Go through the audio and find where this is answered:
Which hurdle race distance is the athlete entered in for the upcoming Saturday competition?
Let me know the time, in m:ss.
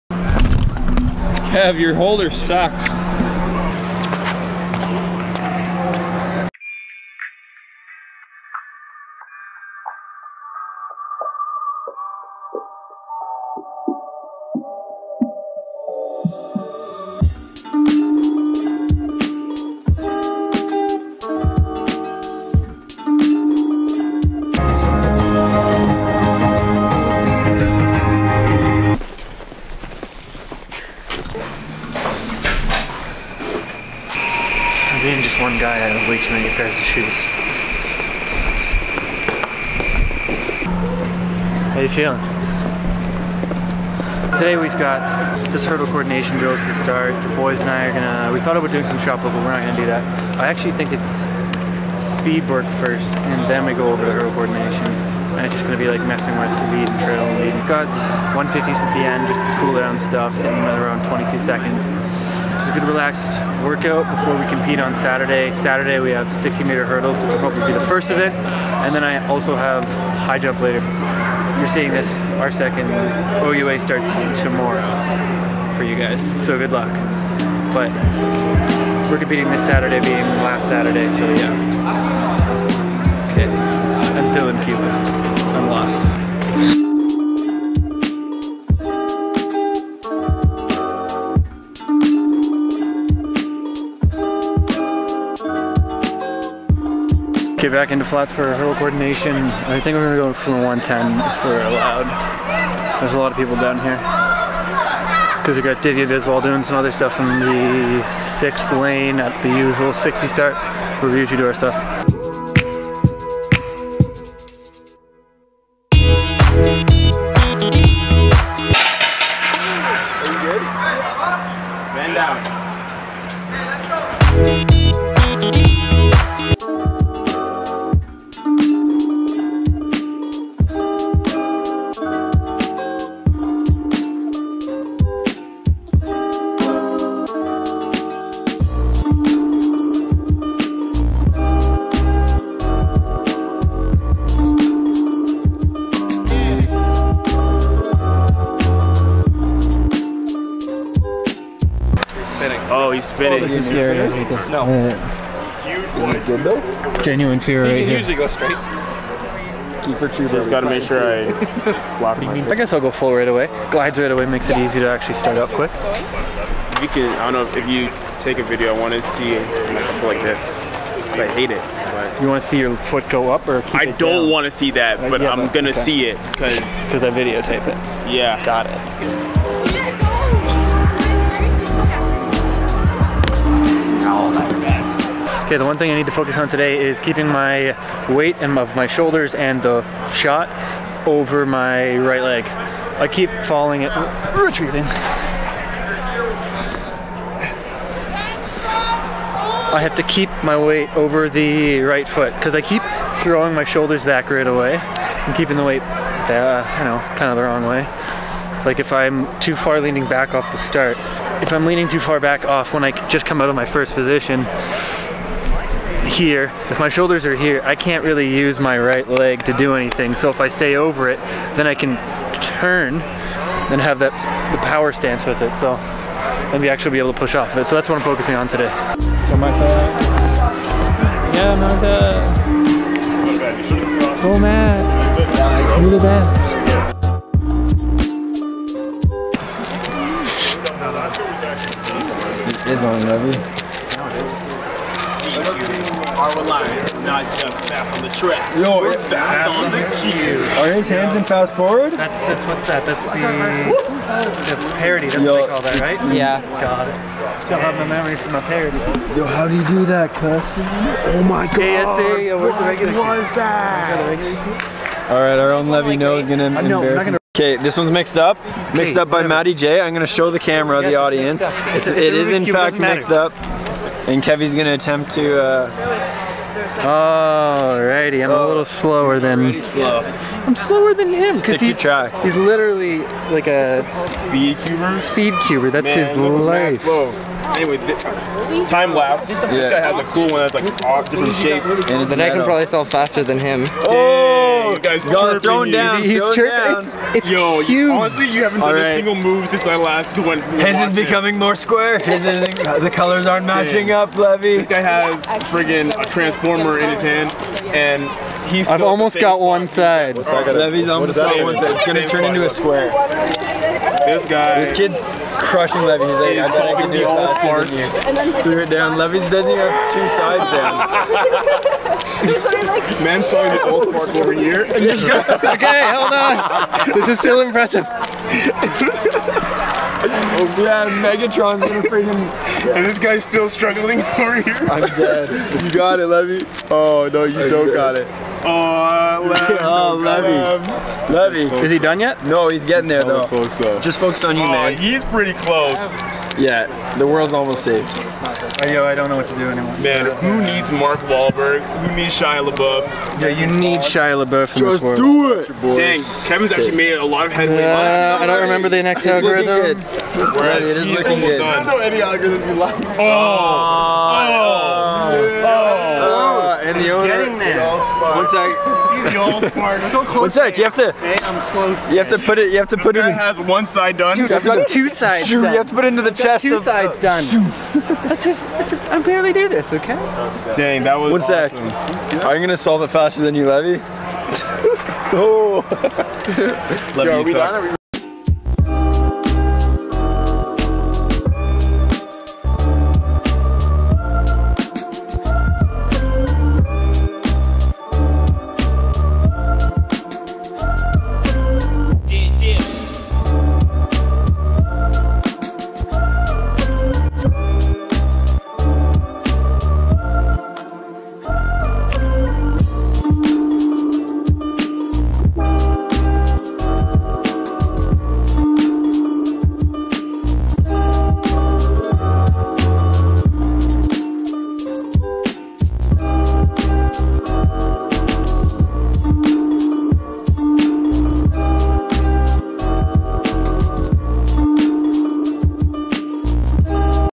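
1:06.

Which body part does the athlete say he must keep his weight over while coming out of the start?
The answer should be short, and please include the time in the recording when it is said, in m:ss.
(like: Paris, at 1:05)
Right foot, at 3:21.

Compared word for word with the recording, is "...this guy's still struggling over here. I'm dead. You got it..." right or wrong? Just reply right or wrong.
right.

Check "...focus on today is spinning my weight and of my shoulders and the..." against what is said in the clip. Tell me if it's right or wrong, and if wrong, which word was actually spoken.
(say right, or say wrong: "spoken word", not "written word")
wrong: "keeping", not "spinning".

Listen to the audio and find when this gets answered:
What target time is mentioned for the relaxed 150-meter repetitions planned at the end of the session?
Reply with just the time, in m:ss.
1:01.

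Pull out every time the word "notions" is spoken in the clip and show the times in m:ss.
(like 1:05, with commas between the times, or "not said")
not said.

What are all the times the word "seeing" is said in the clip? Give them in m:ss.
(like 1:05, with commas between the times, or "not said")
1:11.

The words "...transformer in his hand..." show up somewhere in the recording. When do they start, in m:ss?
5:06.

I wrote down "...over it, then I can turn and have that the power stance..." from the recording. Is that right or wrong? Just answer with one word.
right.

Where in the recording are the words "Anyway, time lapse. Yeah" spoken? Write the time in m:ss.
4:47.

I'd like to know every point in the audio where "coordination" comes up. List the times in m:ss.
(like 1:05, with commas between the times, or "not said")
0:45, 0:54, 1:38.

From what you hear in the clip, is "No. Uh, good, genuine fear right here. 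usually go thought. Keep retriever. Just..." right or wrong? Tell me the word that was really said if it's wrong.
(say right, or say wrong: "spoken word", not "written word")
wrong: "straight", not "thought".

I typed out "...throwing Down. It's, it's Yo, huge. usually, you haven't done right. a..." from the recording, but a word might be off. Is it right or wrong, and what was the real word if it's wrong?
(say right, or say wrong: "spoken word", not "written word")
wrong: "honestly", not "usually".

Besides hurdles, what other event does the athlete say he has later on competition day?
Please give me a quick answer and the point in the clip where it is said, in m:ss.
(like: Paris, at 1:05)
High jump, at 1:10.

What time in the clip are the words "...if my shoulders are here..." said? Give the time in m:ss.
3:36.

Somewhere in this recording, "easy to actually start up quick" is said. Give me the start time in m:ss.
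2:44.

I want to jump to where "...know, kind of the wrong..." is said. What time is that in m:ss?
3:26.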